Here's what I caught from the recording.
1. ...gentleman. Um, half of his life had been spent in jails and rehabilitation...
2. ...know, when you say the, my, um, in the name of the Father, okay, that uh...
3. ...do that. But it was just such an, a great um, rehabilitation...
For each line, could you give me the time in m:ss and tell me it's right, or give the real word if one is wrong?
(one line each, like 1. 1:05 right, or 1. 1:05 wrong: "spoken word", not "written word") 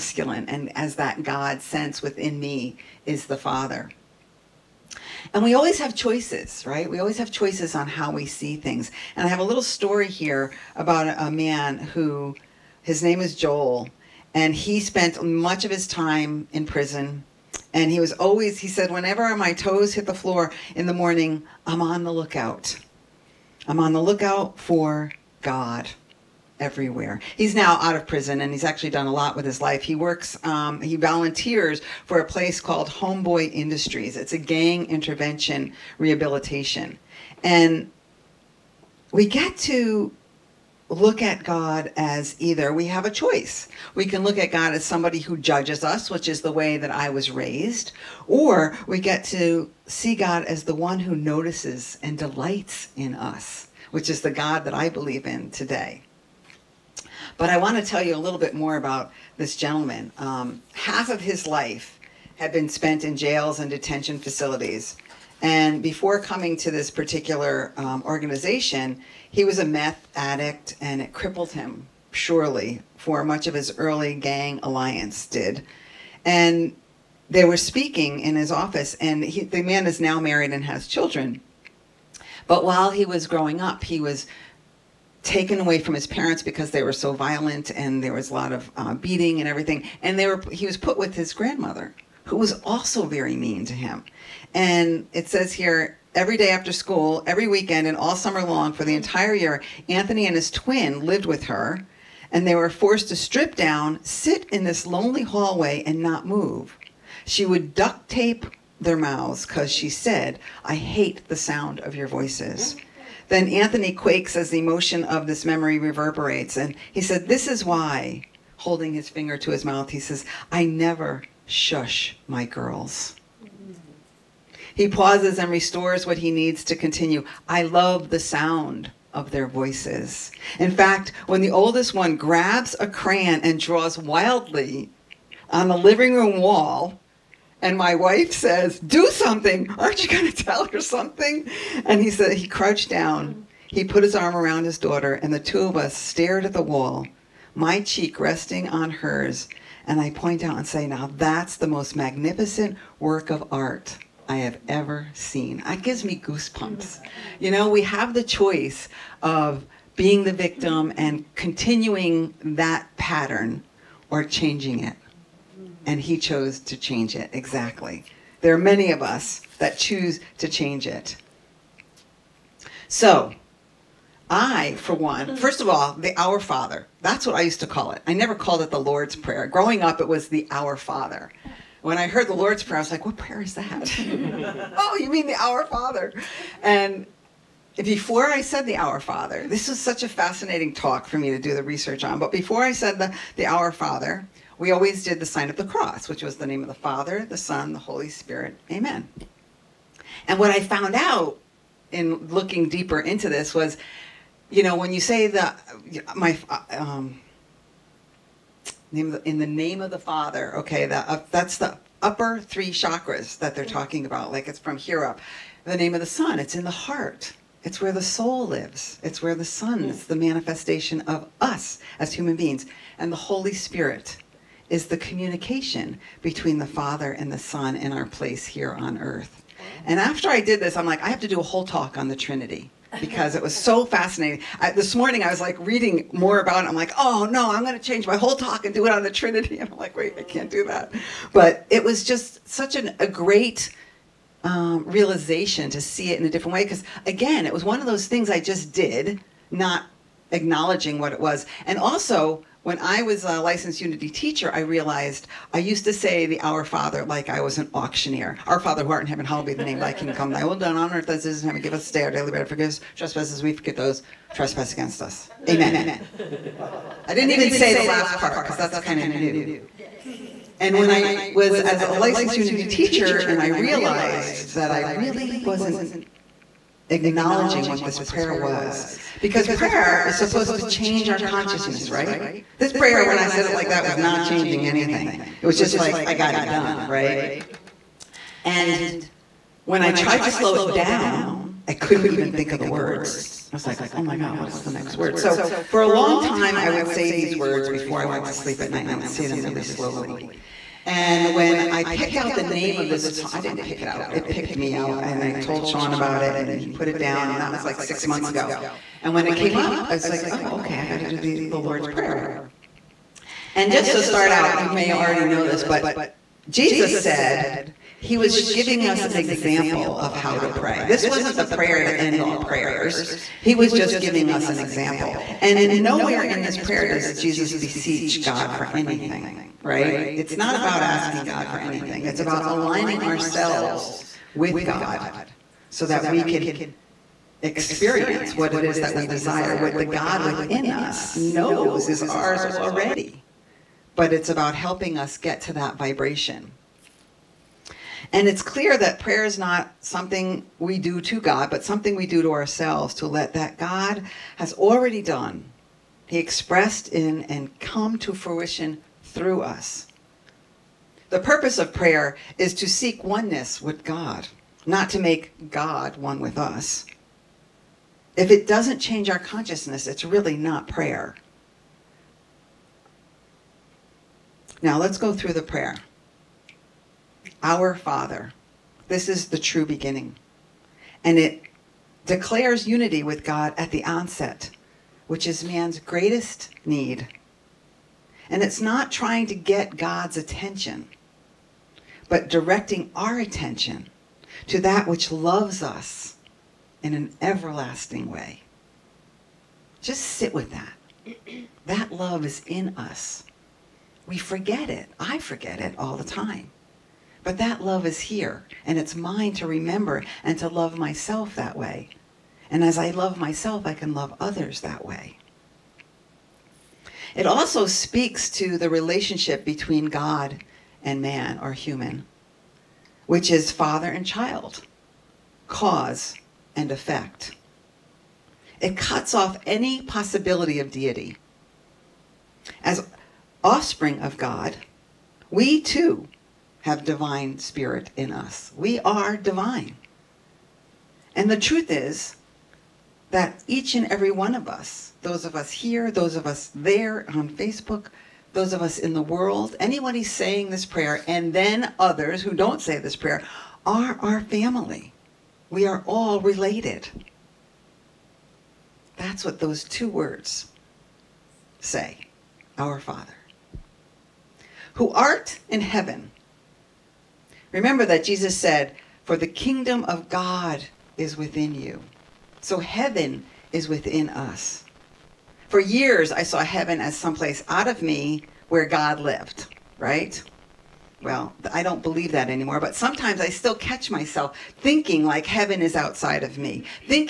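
1. 0:59 wrong: "detention", not "rehabilitation"
2. 3:24 right
3. 4:00 wrong: "realization", not "rehabilitation".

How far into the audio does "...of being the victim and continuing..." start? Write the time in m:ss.
2:39.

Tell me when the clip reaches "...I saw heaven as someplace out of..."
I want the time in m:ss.
7:56.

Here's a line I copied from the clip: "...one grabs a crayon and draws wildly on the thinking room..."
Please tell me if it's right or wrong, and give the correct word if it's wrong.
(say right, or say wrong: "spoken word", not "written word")
wrong: "living", not "thinking".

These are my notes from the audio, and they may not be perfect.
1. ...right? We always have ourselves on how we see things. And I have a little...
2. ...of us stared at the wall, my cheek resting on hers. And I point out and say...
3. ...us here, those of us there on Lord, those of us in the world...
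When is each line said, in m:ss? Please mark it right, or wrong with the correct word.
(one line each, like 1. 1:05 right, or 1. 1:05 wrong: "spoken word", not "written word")
1. 0:06 wrong: "choices", not "ourselves"
2. 2:25 right
3. 7:25 wrong: "Facebook", not "Lord".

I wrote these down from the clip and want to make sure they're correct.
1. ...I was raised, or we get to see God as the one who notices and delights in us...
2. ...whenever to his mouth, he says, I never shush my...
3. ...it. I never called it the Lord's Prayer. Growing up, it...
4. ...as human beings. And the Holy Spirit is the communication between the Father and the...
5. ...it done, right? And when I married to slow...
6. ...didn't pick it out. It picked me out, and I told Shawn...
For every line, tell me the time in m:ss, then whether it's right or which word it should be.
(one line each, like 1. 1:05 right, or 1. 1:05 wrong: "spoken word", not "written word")
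1. 0:46 right
2. 1:59 wrong: "finger", not "whenever"
3. 2:57 right
4. 3:41 right
5. 4:46 wrong: "tried", not "married"
6. 5:03 right.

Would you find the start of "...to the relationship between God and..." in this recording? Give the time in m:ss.
6:58.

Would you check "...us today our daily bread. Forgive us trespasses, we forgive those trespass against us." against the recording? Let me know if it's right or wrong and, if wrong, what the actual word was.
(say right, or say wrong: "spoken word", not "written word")
right.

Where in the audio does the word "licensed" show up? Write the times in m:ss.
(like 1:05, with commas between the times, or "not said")
4:13, 4:31.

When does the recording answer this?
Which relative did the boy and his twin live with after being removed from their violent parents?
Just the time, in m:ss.
1:31.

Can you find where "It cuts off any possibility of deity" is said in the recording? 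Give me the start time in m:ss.
7:08.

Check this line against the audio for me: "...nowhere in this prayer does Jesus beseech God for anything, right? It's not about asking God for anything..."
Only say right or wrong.
right.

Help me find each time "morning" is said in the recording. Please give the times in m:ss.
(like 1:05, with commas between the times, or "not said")
0:20, 3:54.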